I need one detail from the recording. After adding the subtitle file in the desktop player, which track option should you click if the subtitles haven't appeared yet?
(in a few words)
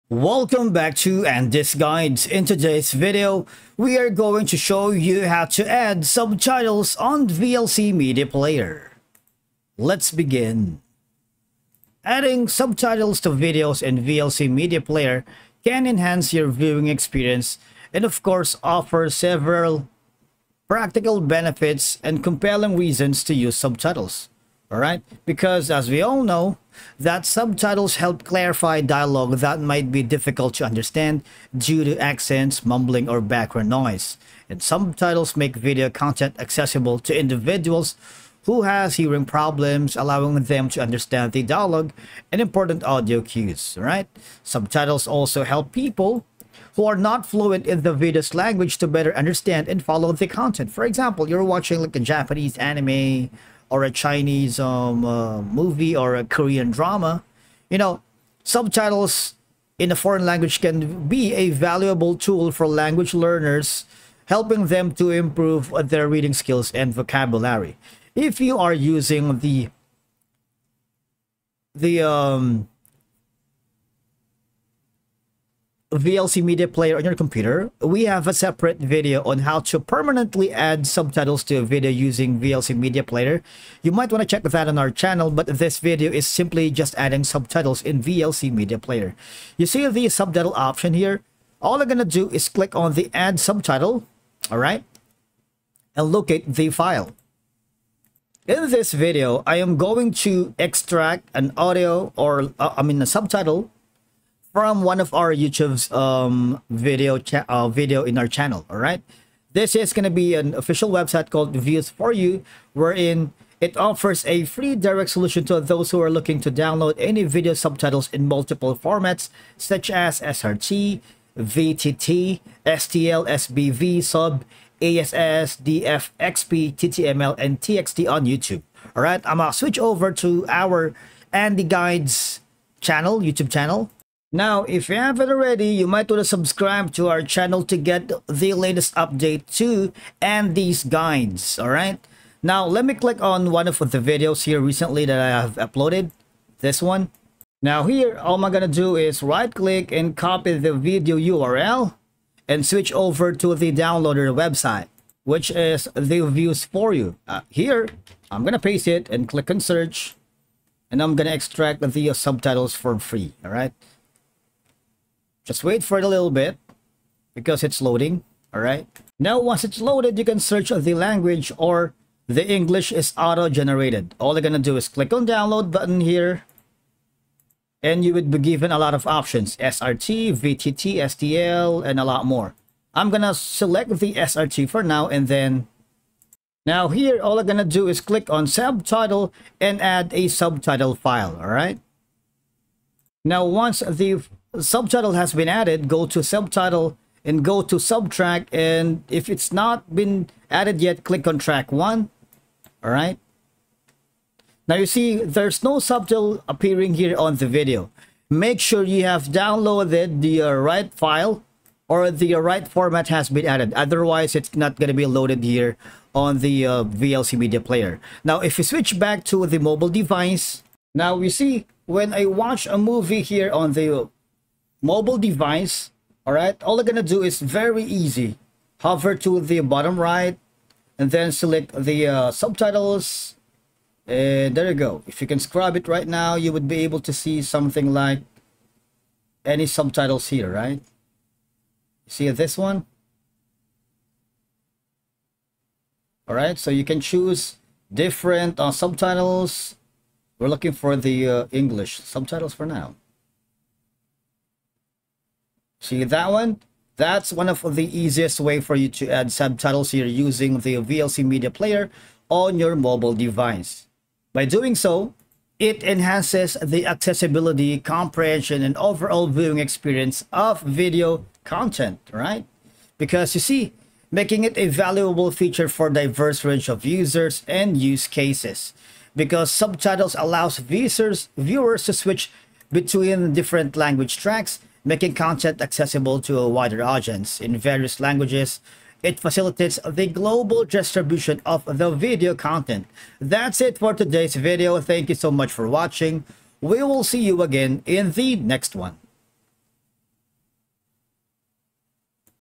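Track one.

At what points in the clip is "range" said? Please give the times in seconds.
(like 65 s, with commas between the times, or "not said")
276 s.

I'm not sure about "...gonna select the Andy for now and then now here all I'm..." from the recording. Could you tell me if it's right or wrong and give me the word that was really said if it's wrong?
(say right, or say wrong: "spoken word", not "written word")
wrong: "SRT", not "Andy".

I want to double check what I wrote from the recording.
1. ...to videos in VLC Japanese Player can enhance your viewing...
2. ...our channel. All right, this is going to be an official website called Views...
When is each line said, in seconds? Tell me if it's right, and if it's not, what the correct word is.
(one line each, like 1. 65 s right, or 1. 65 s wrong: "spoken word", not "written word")
1. 13 s wrong: "Media", not "Japanese"
2. 108 s right.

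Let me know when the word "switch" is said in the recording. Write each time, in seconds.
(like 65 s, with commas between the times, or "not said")
129 s, 152 s, 218 s, 281 s.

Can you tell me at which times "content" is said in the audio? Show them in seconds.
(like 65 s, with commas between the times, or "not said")
35 s, 50 s, 271 s, 285 s, 292 s.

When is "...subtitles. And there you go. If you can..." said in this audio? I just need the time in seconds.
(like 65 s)
232 s.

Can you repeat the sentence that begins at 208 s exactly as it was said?
Make sure you have downloaded the uh, right file or the uh, right format has been added.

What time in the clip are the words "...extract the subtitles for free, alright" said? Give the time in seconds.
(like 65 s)
161 s.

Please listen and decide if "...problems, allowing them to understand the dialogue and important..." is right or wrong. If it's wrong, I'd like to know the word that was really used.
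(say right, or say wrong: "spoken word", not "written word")
right.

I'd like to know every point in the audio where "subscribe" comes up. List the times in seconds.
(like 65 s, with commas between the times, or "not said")
136 s.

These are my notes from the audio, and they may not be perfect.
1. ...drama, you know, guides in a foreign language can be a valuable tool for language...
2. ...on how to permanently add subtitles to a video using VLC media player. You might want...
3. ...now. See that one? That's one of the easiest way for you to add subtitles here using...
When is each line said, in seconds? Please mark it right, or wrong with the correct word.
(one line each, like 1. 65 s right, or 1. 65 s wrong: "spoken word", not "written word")
1. 56 s wrong: "subtitles", not "guides"
2. 79 s right
3. 252 s right.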